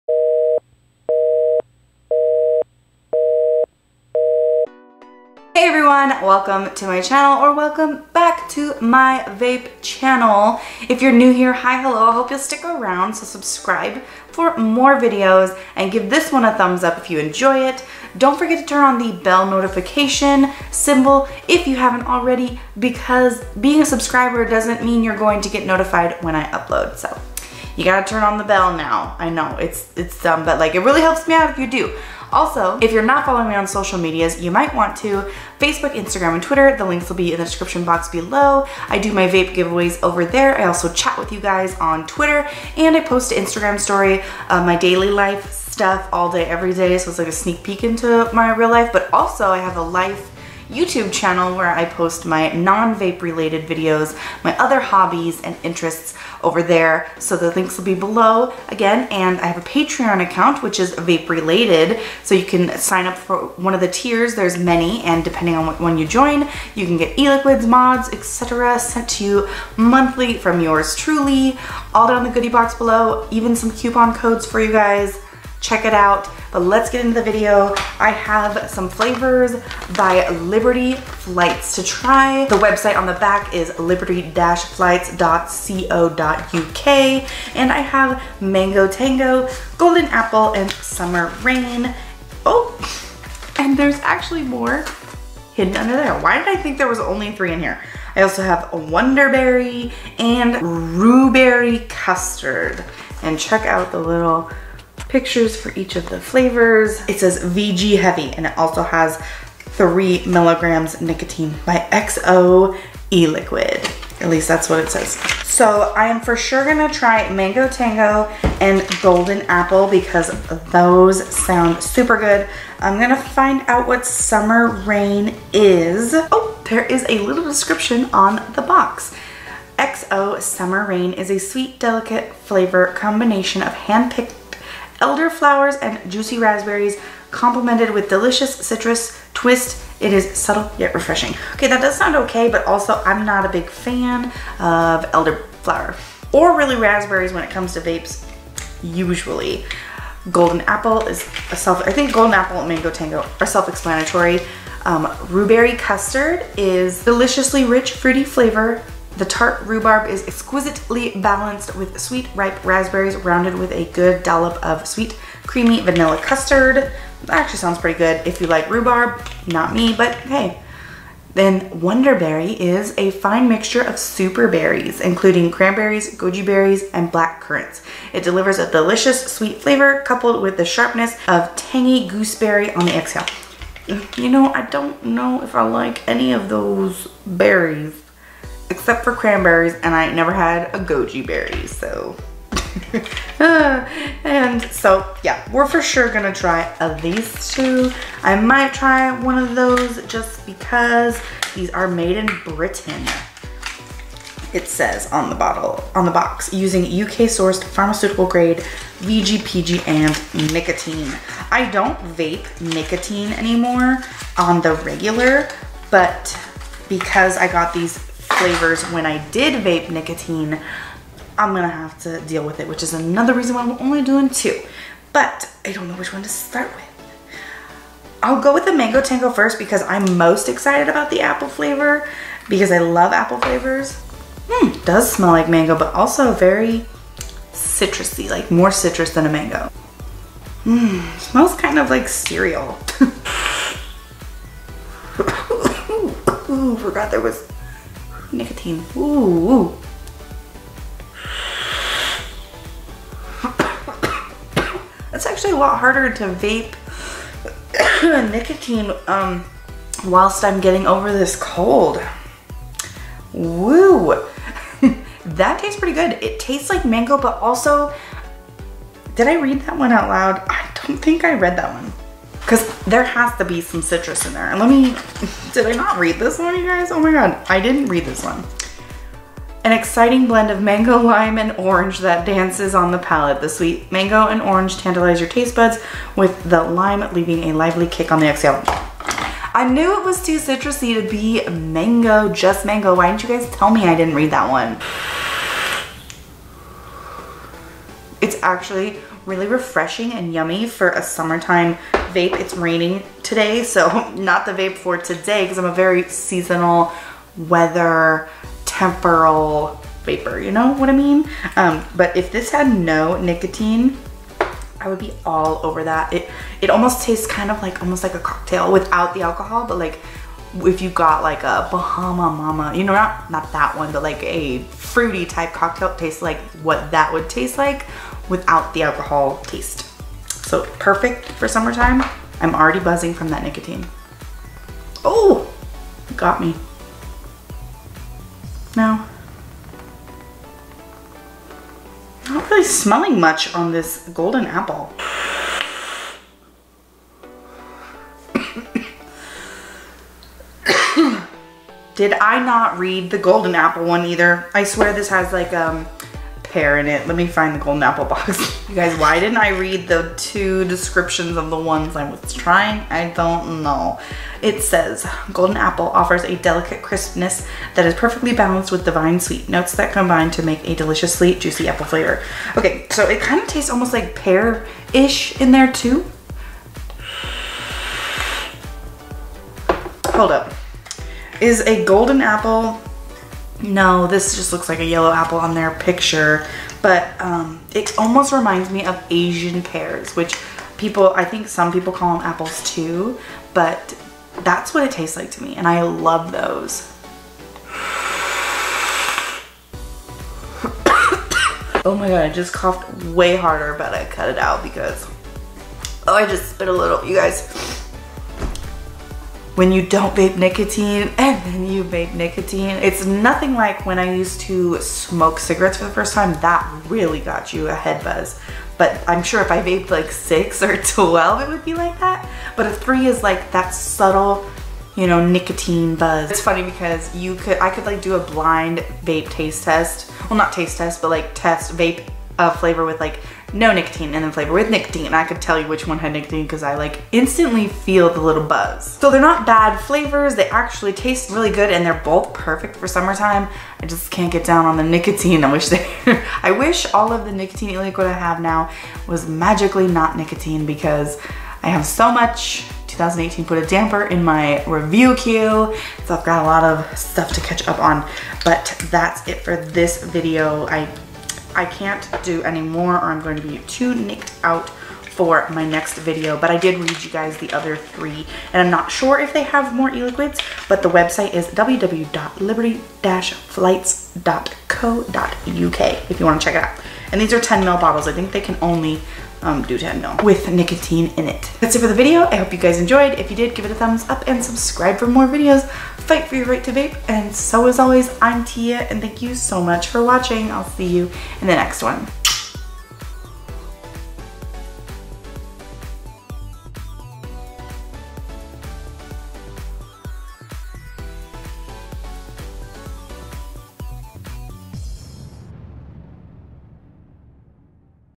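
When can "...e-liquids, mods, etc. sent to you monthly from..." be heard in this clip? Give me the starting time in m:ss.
1:07.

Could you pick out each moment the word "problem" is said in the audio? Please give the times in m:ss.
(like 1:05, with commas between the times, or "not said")
not said.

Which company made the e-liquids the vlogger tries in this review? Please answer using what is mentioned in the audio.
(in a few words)
Liberty Flights.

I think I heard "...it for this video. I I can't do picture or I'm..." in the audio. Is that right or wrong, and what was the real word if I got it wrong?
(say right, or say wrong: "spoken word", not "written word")
wrong: "anymore", not "picture".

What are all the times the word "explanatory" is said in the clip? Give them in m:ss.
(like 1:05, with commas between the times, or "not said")
2:33.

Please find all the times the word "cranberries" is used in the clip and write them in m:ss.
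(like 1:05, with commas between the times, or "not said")
2:55, 3:09.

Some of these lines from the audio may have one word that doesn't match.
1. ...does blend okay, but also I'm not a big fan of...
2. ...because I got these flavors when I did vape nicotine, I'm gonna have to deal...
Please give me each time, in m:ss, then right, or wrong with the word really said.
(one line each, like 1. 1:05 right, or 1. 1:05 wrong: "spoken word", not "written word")
1. 2:21 wrong: "sound", not "blend"
2. 3:36 right.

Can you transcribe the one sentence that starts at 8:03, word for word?
If you did, give it a thumbs up and subscribe for more videos.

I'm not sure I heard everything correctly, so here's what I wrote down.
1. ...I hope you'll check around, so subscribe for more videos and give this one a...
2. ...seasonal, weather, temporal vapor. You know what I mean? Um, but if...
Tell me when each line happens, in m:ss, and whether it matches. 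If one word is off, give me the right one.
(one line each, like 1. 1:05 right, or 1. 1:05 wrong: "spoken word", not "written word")
1. 0:12 wrong: "stick", not "check"
2. 5:06 right.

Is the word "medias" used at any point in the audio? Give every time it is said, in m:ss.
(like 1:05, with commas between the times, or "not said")
0:33.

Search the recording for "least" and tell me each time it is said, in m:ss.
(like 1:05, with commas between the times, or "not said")
1:54.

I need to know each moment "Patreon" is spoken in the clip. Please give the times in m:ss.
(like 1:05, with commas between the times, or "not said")
0:59.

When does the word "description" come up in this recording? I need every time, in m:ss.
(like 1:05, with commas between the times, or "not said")
0:37, 2:07, 6:00.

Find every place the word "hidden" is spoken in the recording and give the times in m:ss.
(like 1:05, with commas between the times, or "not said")
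1:35.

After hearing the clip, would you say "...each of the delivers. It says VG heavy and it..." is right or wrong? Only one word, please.
wrong.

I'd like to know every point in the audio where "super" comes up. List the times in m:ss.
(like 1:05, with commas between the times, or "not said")
2:01, 2:53.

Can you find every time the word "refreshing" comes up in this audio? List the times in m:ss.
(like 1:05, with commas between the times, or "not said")
2:20, 4:59.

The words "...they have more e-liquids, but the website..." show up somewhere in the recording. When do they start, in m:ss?
7:49.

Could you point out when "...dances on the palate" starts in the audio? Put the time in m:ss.
4:42.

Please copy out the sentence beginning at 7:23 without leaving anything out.
I just can't get down on the nicotine.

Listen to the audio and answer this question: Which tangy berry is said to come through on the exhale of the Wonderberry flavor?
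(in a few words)
Gooseberry.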